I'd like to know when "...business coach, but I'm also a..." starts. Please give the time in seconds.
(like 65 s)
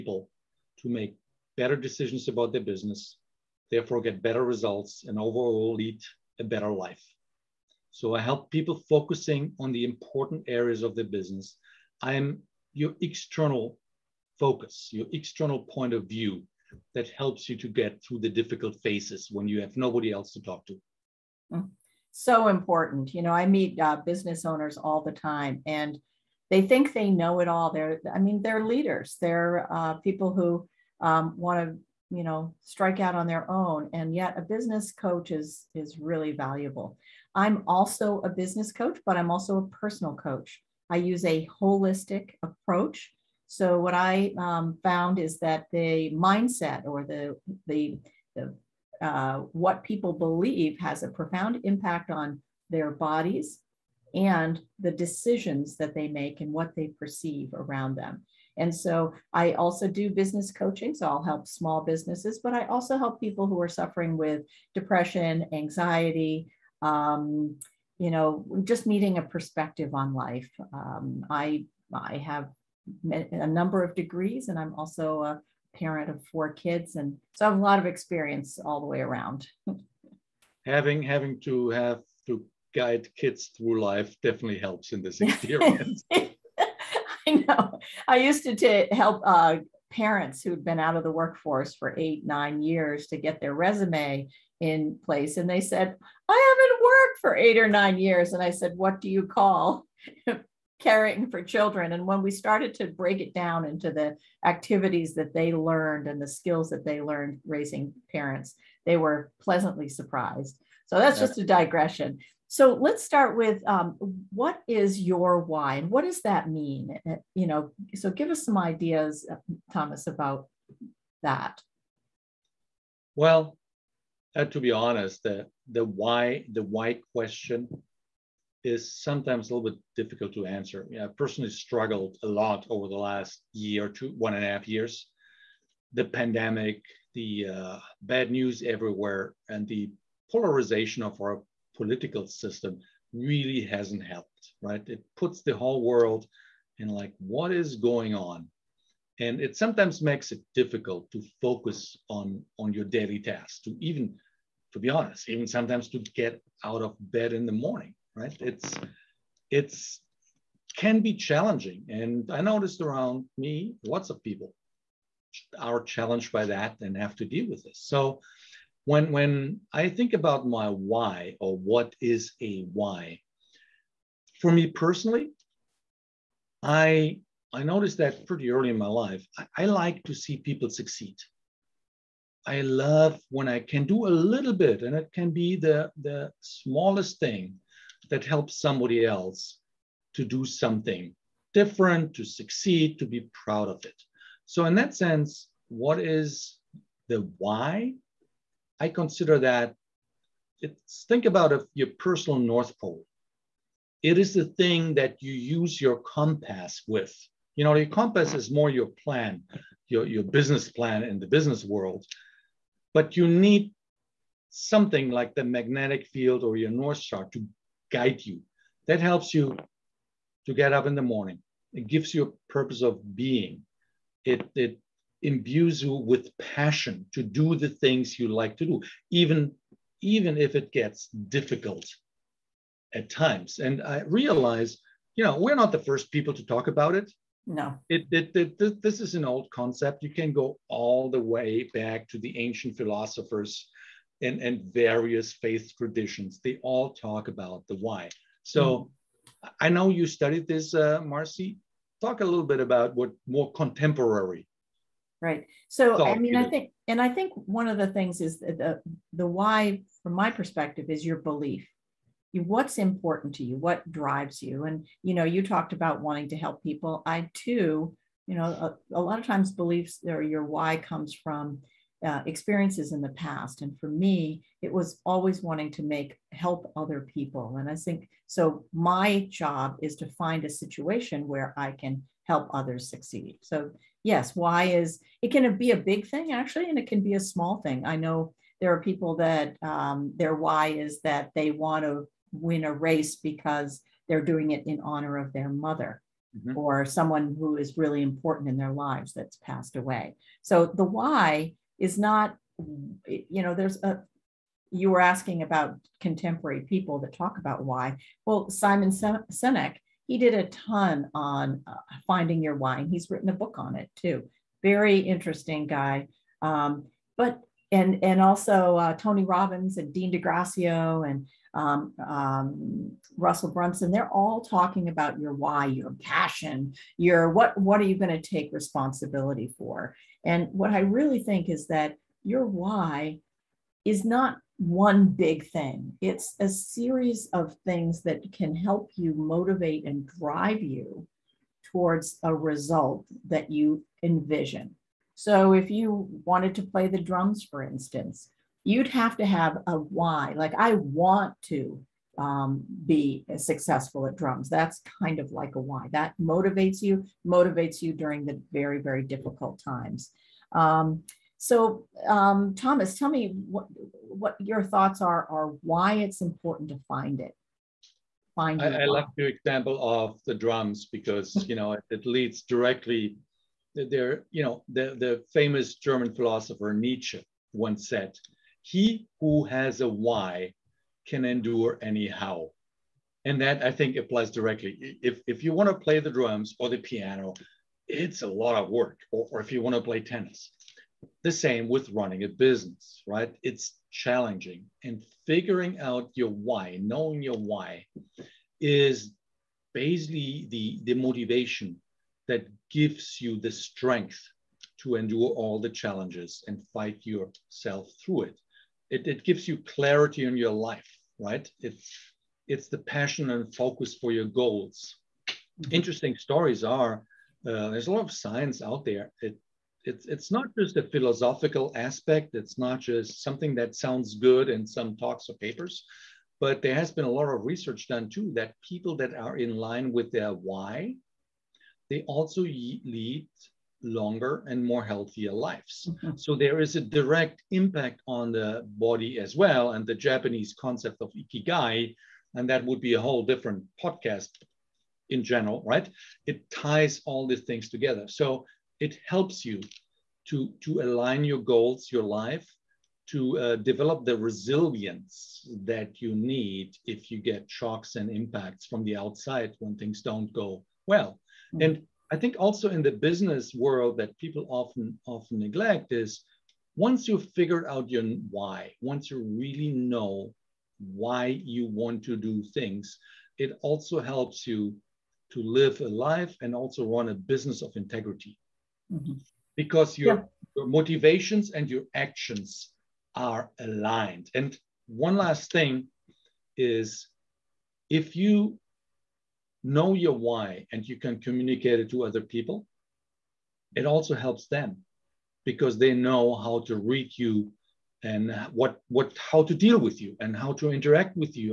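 38 s.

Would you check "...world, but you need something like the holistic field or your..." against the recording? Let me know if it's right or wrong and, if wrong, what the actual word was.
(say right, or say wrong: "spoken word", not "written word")
wrong: "magnetic", not "holistic".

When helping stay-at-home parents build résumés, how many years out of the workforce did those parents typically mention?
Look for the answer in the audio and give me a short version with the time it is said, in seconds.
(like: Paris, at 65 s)
8 or 9, at 91 s.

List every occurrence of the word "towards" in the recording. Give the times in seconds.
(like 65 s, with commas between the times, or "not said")
341 s.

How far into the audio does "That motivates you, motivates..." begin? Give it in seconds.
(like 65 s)
355 s.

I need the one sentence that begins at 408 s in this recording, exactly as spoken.
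It, it gives you clarity in your life right?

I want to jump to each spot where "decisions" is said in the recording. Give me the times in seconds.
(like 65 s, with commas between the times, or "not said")
1 s, 54 s.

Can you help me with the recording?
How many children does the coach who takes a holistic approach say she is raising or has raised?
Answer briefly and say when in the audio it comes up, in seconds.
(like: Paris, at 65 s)
4, at 76 s.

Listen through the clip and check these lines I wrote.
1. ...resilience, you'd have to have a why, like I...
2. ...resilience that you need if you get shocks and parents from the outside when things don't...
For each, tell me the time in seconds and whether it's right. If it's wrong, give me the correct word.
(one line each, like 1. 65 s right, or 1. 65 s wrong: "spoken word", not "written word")
1. 347 s wrong: "instance", not "resilience"
2. 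454 s wrong: "impacts", not "parents".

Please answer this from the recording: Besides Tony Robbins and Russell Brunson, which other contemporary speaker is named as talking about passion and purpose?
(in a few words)
Dean Graziosi.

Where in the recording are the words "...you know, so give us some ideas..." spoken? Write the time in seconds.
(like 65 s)
117 s.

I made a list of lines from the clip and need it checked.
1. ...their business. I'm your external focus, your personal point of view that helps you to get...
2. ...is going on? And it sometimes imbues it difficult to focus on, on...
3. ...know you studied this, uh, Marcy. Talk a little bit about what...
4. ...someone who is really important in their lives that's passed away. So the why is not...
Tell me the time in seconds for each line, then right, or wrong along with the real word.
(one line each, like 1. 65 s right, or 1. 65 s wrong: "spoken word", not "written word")
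1. 10 s wrong: "external", not "personal"
2. 147 s wrong: "makes", not "imbues"
3. 249 s right
4. 296 s right.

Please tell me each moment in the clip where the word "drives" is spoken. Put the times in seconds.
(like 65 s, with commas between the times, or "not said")
263 s, 340 s.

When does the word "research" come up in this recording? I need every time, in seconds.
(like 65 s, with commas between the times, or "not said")
427 s.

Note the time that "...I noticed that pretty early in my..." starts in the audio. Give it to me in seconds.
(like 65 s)
177 s.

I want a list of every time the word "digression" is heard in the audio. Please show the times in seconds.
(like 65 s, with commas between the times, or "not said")
111 s.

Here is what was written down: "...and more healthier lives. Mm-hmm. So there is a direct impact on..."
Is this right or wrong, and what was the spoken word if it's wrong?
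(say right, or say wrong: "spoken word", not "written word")
right.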